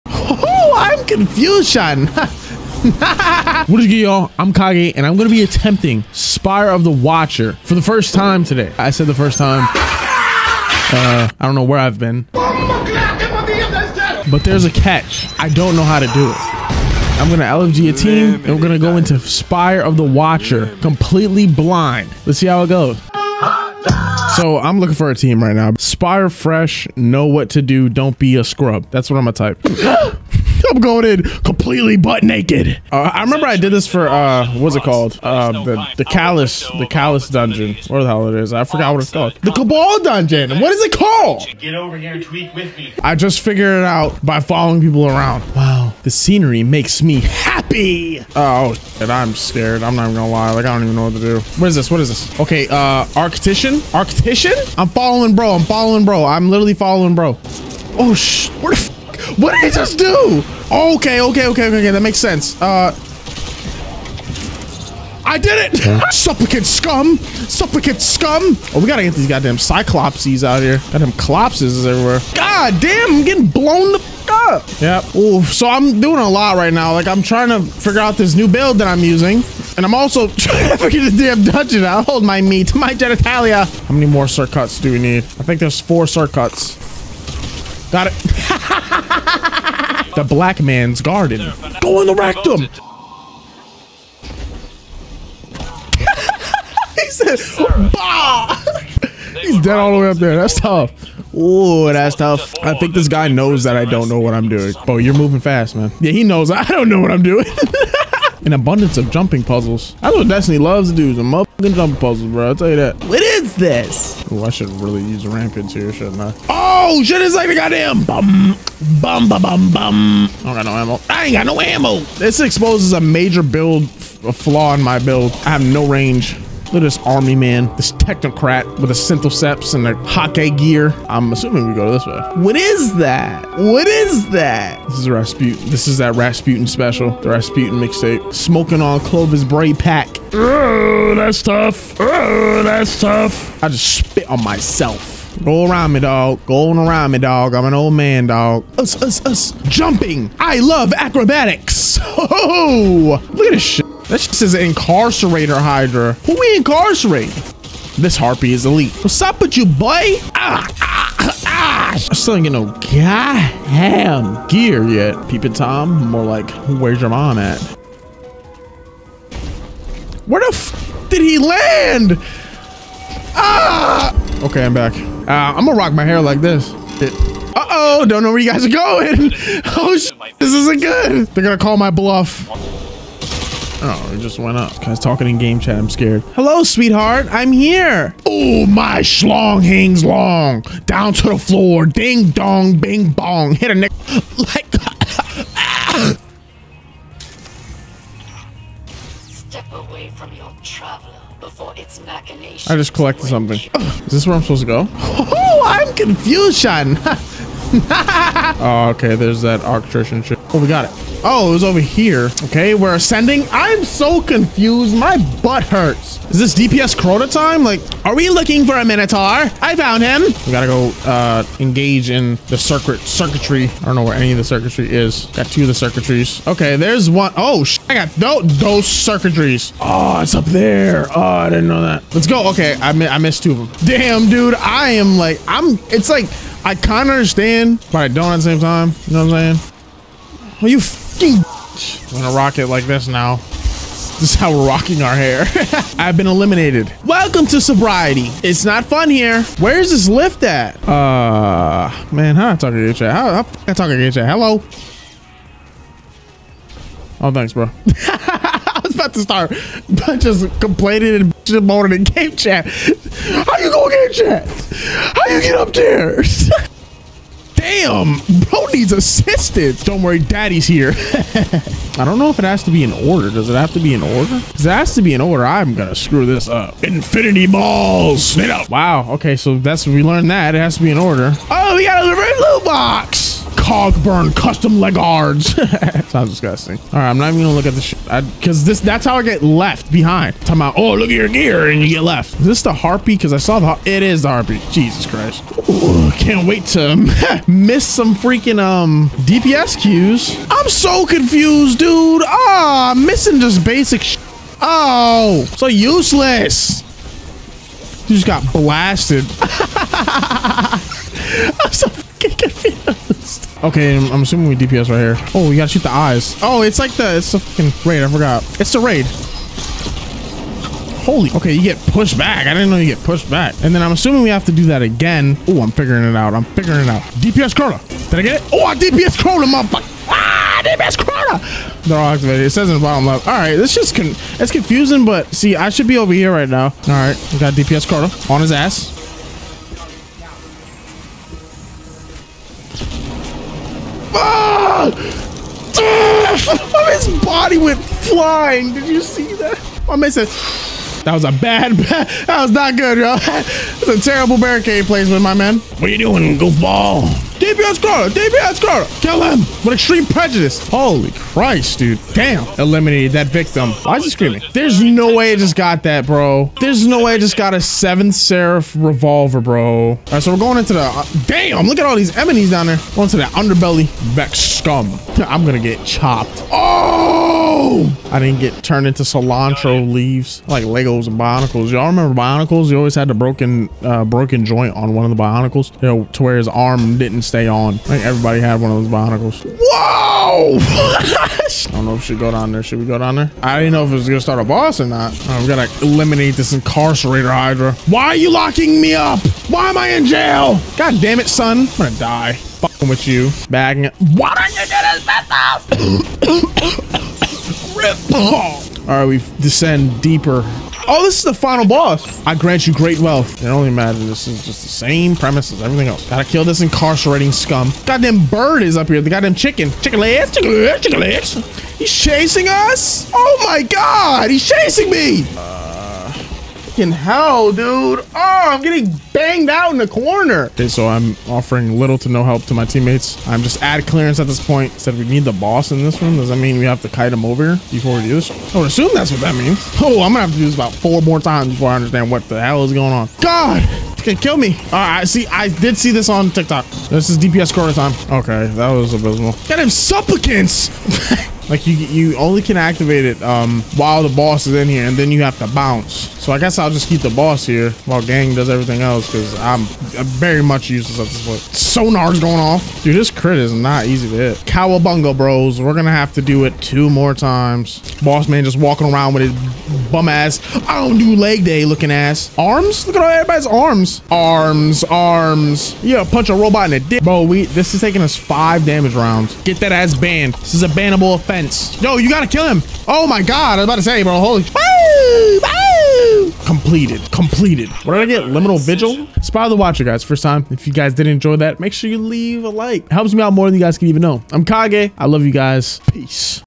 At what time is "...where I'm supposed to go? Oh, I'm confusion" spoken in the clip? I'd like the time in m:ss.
3:24.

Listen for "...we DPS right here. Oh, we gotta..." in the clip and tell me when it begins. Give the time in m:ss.
5:14.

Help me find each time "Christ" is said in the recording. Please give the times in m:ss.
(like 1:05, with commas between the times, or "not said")
4:55, 6:01.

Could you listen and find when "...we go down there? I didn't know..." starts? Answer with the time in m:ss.
6:32.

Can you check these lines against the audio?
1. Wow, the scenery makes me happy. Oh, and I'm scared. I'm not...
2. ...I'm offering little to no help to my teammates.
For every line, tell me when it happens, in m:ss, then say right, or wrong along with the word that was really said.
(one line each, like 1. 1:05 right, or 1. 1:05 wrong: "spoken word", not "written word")
1. 0:45 right
2. 7:10 right.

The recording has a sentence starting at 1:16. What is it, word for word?
Like, I'm trying to figure out this new build that I'm using.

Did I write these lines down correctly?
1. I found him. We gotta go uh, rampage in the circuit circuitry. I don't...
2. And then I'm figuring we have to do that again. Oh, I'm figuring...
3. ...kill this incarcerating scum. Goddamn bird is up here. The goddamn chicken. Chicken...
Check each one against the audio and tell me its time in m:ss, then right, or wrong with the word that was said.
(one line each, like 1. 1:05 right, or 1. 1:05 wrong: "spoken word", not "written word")
1. 3:39 wrong: "engage", not "rampage"
2. 5:23 wrong: "assuming", not "figuring"
3. 6:56 right.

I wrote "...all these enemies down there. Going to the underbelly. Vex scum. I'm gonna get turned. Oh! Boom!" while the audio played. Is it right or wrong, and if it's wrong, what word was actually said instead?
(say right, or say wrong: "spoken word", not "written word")
wrong: "chopped", not "turned".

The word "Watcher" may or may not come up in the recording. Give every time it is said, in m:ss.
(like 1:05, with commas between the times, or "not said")
0:06, 0:20, 8:09.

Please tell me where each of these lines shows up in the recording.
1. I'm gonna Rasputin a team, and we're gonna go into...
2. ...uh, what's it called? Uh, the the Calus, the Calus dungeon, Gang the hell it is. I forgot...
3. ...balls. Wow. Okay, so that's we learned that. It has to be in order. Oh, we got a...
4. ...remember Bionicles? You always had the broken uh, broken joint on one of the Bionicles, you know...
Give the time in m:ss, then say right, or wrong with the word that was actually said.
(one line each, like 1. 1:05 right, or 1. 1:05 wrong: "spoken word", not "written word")
1. 0:17 wrong: "LFG", not "Rasputin"
2. 0:34 wrong: "What", not "Gang"
3. 4:37 right
4. 6:21 right.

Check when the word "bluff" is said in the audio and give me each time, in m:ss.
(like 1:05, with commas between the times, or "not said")
3:01.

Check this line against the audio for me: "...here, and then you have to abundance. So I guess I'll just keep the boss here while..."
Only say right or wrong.
wrong.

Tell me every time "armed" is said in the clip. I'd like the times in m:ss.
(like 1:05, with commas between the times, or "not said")
not said.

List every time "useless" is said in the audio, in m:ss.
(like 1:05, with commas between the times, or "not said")
5:05, 7:40.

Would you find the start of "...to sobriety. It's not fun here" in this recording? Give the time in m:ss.
4:07.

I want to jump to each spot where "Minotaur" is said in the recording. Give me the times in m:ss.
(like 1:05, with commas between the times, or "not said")
3:38.